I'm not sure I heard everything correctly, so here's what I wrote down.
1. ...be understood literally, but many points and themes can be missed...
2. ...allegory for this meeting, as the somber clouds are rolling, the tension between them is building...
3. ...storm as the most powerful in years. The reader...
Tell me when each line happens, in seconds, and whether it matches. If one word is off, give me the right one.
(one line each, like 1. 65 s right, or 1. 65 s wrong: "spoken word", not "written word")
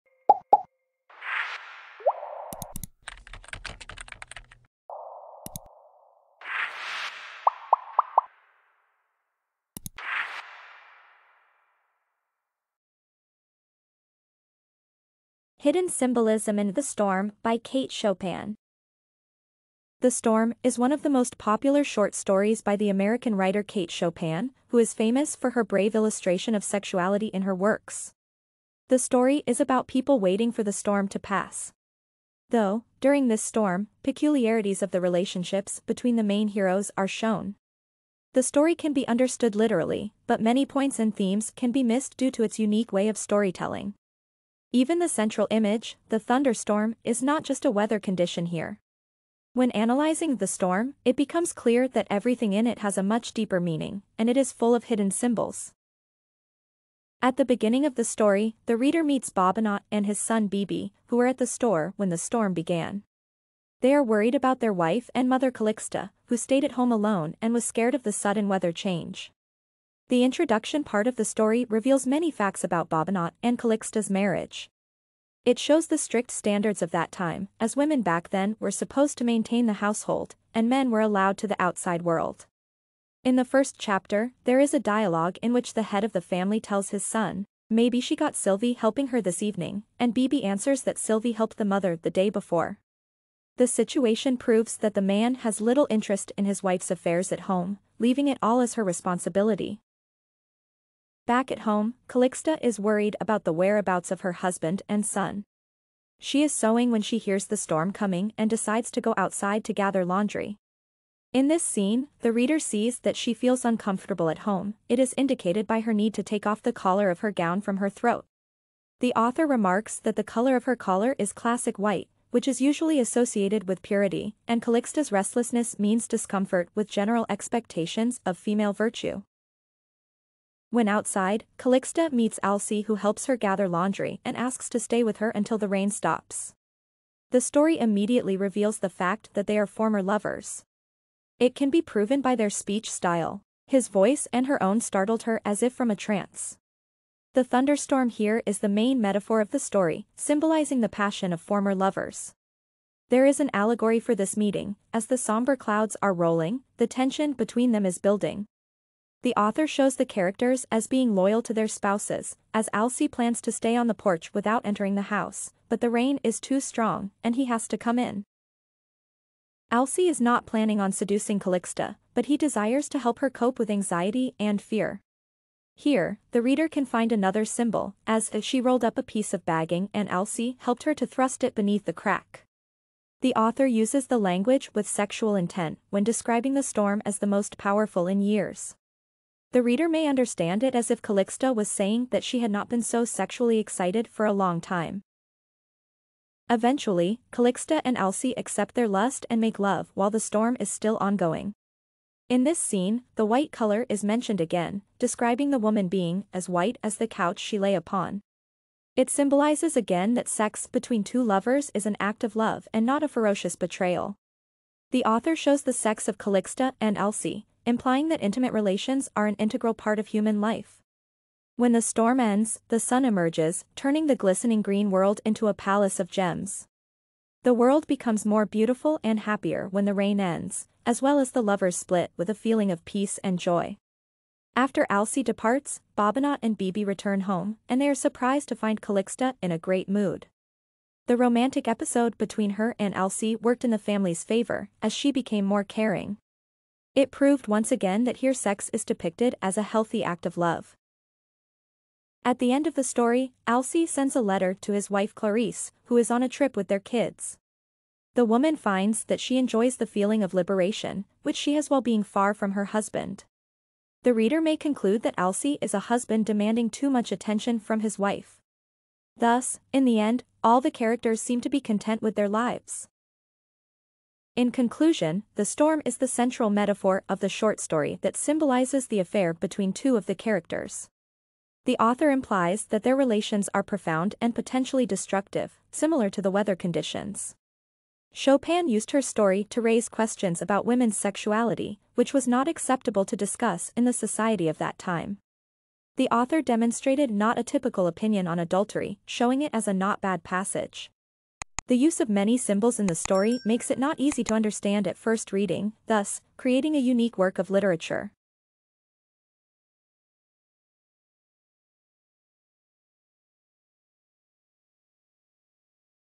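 1. 38 s right
2. 153 s right
3. 186 s right.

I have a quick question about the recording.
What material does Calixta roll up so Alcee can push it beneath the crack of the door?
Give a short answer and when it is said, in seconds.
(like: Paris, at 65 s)
a piece of bagging, at 178 s.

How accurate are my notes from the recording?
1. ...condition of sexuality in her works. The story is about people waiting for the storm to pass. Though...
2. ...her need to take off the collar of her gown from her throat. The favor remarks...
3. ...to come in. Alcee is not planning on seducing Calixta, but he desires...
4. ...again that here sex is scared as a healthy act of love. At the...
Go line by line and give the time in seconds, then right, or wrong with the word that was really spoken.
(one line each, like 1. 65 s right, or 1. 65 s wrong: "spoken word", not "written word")
1. 25 s wrong: "illustration", not "condition"
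2. 115 s wrong: "author", not "favor"
3. 167 s right
4. 247 s wrong: "depicted", not "scared".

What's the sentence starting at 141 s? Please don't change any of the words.
It can be proven by their speech style.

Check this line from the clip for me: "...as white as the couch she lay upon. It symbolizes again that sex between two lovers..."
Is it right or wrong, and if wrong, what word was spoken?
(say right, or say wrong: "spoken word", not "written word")
right.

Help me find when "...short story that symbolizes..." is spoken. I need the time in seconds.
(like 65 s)
277 s.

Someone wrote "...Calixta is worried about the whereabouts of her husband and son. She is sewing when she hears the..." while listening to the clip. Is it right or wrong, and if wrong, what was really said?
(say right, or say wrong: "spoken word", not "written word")
right.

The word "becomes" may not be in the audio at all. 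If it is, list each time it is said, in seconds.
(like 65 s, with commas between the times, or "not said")
51 s, 227 s.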